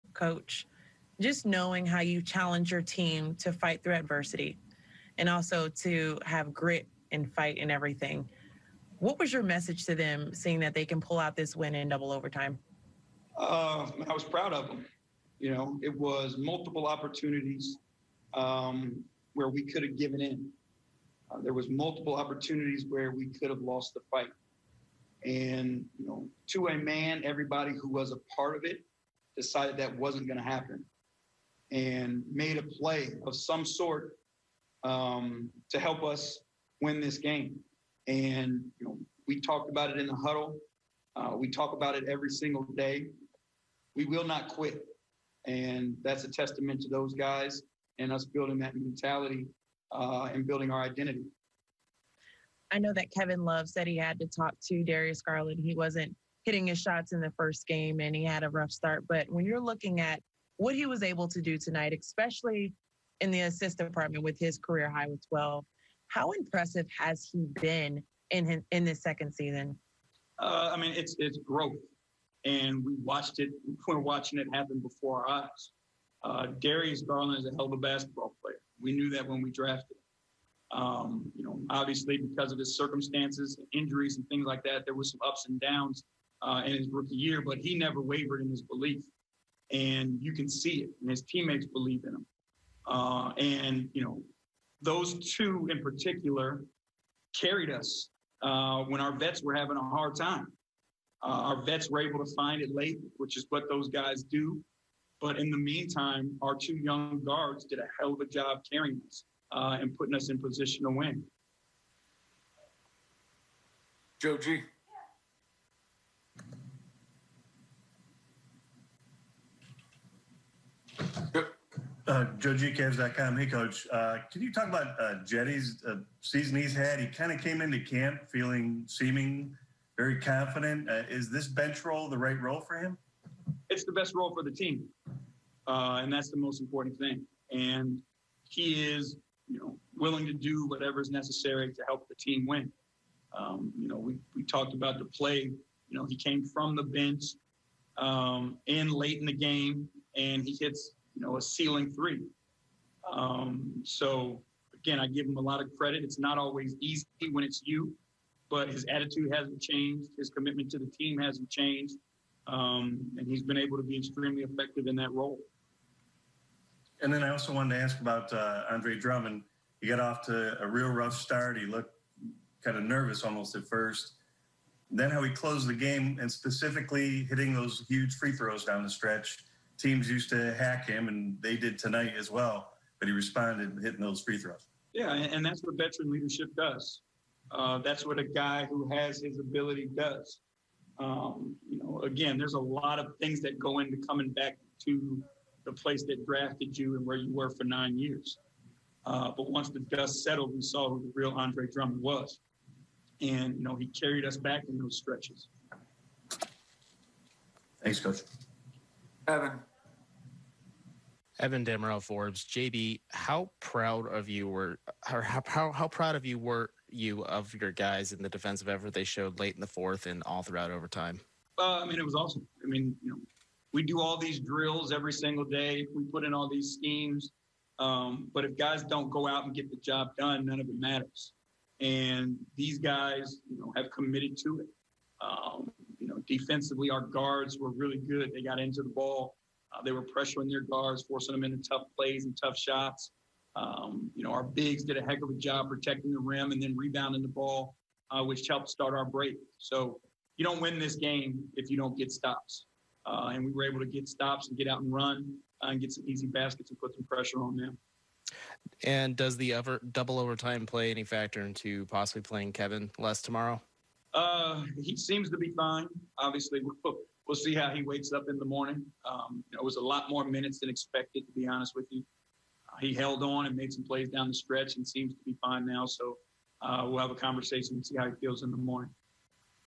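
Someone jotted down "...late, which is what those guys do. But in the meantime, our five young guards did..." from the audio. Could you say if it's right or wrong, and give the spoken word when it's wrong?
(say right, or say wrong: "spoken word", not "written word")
wrong: "two", not "five".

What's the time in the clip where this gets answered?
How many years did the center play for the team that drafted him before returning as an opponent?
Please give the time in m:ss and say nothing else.
3:17.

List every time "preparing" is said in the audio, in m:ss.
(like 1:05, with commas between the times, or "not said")
not said.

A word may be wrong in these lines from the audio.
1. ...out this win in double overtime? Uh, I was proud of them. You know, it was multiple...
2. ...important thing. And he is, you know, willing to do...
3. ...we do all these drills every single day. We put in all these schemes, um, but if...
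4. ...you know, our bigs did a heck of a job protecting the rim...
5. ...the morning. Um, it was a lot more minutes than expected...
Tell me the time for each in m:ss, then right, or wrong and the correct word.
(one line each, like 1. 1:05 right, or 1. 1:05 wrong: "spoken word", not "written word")
1. 0:11 right
2. 2:16 right
3. 3:43 right
4. 4:04 right
5. 4:28 right.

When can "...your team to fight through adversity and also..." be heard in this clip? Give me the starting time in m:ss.
0:02.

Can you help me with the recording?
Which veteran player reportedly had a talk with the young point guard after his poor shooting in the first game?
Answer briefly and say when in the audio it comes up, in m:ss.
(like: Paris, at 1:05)
Kevin Love, at 0:53.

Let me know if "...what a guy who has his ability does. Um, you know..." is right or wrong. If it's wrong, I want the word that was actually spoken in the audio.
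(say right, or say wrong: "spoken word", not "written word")
right.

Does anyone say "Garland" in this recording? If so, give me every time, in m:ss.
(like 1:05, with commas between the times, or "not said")
0:55, 1:17.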